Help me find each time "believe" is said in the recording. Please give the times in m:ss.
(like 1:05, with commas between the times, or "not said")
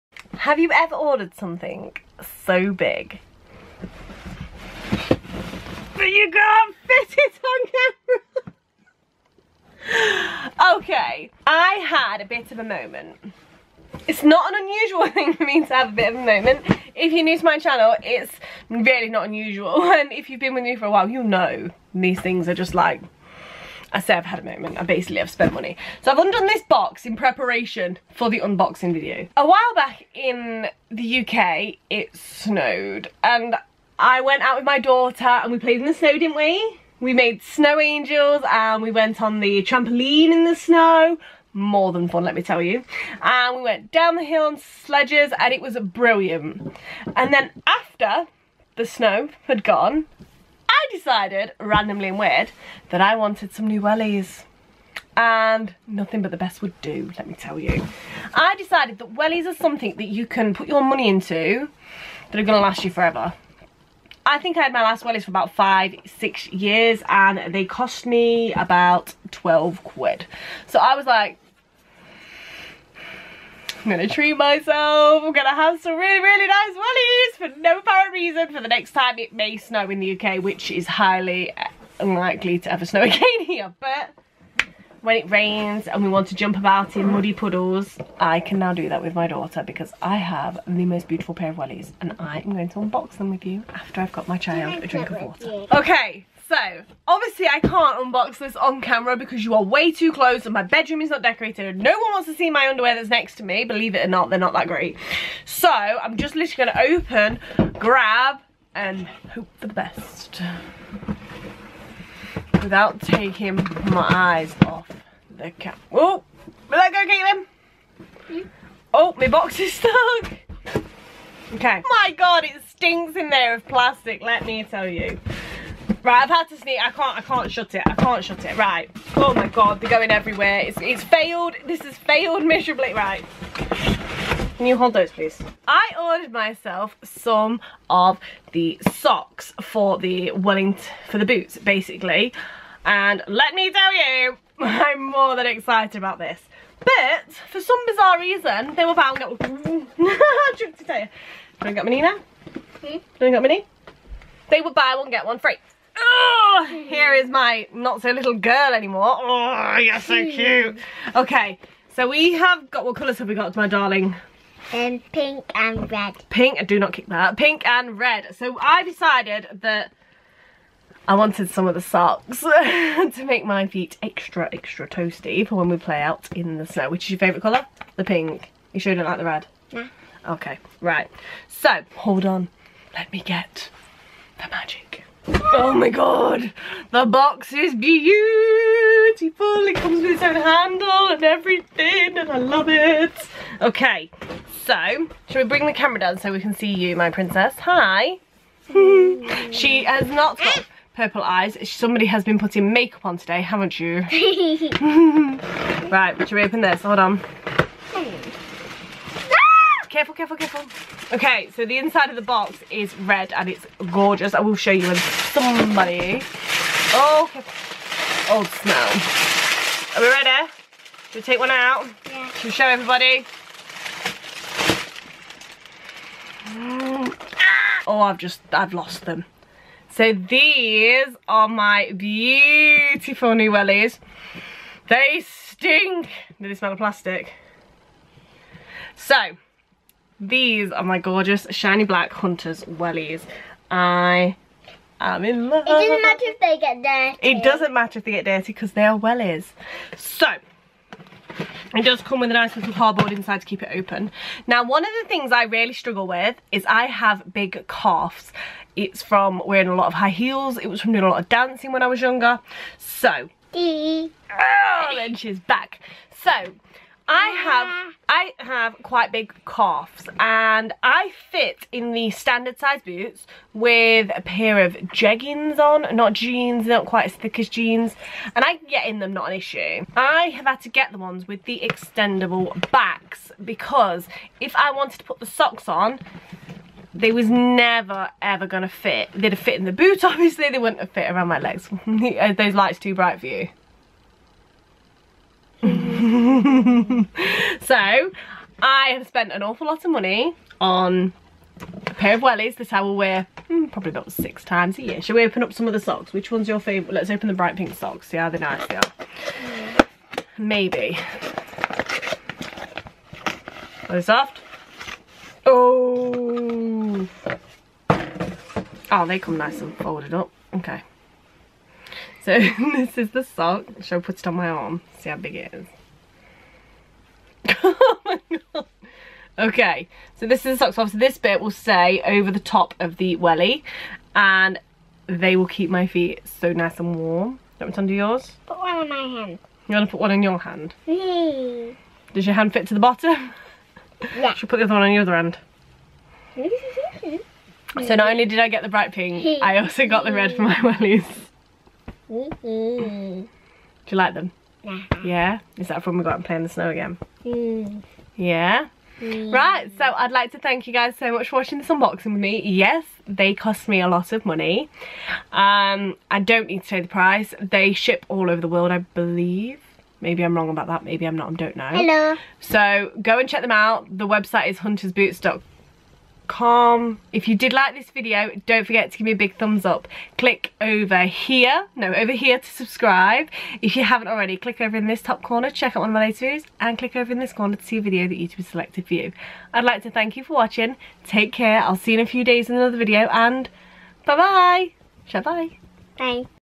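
1:43, 6:08.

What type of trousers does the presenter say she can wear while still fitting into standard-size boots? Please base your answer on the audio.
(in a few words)
jeggings.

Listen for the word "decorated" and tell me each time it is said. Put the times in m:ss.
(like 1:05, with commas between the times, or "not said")
1:41.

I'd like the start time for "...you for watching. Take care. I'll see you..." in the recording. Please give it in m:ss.
6:30.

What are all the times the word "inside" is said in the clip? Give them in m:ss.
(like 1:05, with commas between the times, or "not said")
3:31, 4:13.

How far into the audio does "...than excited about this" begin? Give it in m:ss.
2:25.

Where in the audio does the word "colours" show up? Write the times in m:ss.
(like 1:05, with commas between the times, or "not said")
2:42, 2:57.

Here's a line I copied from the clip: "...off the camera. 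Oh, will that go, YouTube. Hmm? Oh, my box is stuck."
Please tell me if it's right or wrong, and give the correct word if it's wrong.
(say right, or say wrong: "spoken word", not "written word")
wrong: "Caitlin", not "YouTube".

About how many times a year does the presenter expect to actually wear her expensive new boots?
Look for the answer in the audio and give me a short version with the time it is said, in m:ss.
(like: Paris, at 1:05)
6, at 5:04.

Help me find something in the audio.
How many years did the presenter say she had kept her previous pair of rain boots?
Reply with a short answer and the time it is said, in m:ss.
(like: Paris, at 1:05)
five, six years, at 1:05.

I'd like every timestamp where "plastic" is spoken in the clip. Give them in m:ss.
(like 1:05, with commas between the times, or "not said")
2:03, 3:56.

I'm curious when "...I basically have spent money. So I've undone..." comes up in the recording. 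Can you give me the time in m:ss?
0:24.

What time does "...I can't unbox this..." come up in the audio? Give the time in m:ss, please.
1:37.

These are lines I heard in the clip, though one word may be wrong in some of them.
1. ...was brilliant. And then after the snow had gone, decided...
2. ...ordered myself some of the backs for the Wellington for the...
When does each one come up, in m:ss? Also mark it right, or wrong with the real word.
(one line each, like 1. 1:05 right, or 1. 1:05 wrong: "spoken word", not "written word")
1. 0:45 right
2. 2:15 wrong: "socks", not "backs".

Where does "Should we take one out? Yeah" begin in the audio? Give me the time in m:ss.
3:41.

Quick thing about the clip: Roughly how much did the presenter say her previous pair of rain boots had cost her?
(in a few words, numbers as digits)
12 quid.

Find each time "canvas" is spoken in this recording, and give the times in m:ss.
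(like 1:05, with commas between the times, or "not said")
not said.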